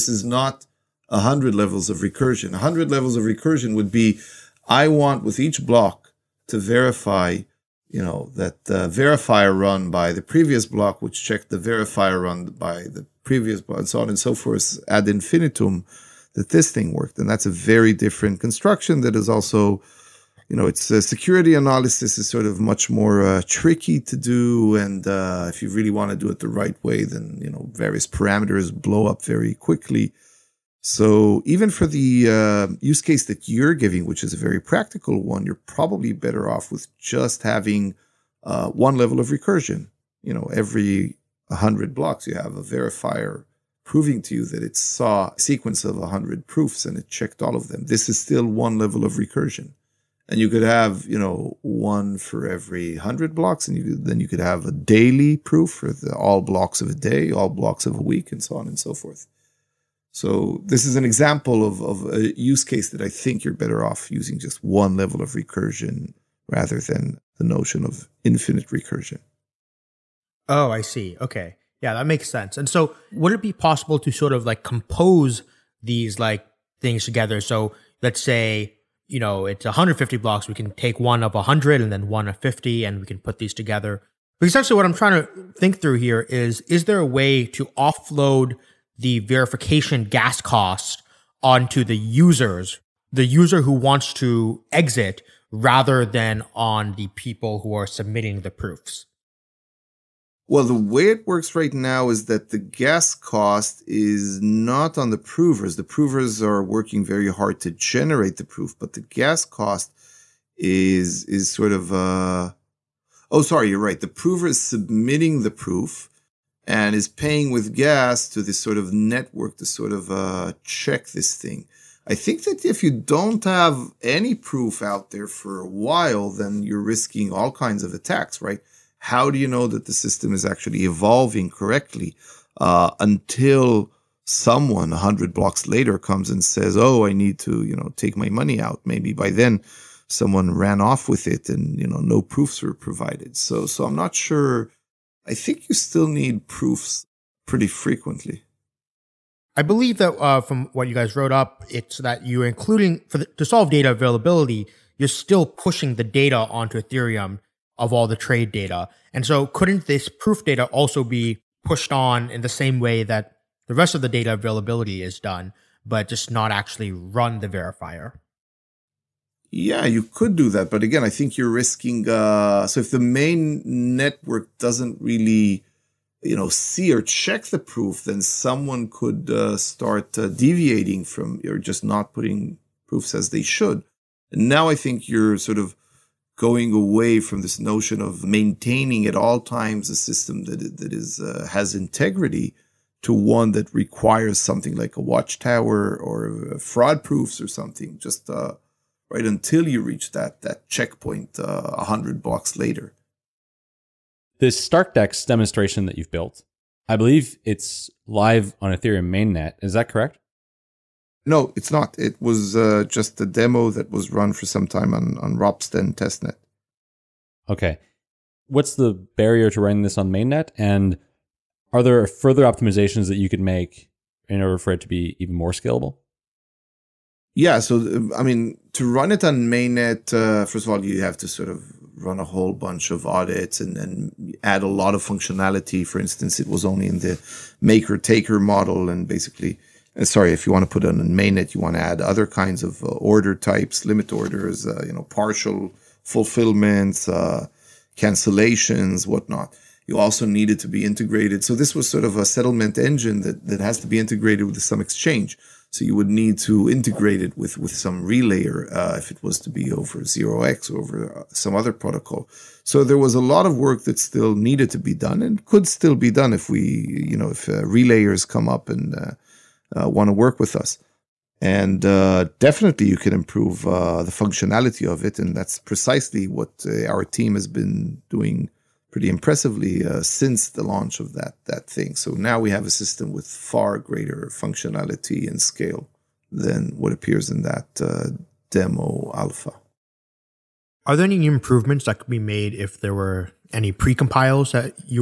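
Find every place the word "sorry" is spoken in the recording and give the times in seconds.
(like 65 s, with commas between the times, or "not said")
113 s, 240 s.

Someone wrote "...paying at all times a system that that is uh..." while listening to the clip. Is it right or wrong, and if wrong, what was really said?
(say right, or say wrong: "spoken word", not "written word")
wrong: "maintaining", not "paying".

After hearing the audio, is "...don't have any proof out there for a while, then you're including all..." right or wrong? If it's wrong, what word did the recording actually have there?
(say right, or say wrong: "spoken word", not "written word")
wrong: "risking", not "including".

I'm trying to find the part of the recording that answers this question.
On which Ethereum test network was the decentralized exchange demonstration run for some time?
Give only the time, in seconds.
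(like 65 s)
215 s.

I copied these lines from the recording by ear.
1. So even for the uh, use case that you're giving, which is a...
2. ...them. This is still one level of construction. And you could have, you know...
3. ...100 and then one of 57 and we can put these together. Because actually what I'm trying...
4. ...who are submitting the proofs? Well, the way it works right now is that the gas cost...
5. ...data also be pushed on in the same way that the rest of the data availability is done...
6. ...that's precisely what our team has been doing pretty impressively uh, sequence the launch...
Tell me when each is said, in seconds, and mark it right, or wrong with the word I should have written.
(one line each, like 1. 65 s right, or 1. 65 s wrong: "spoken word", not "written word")
1. 30 s right
2. 47 s wrong: "recursion", not "construction"
3. 81 s wrong: "50", not "57"
4. 97 s right
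5. 160 s right
6. 275 s wrong: "since", not "sequence".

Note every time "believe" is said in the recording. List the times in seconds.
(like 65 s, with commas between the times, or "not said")
149 s, 206 s.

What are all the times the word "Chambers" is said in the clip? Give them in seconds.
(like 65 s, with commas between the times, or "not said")
not said.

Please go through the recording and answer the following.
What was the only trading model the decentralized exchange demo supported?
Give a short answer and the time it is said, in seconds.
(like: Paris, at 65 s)
maker taker, at 237 s.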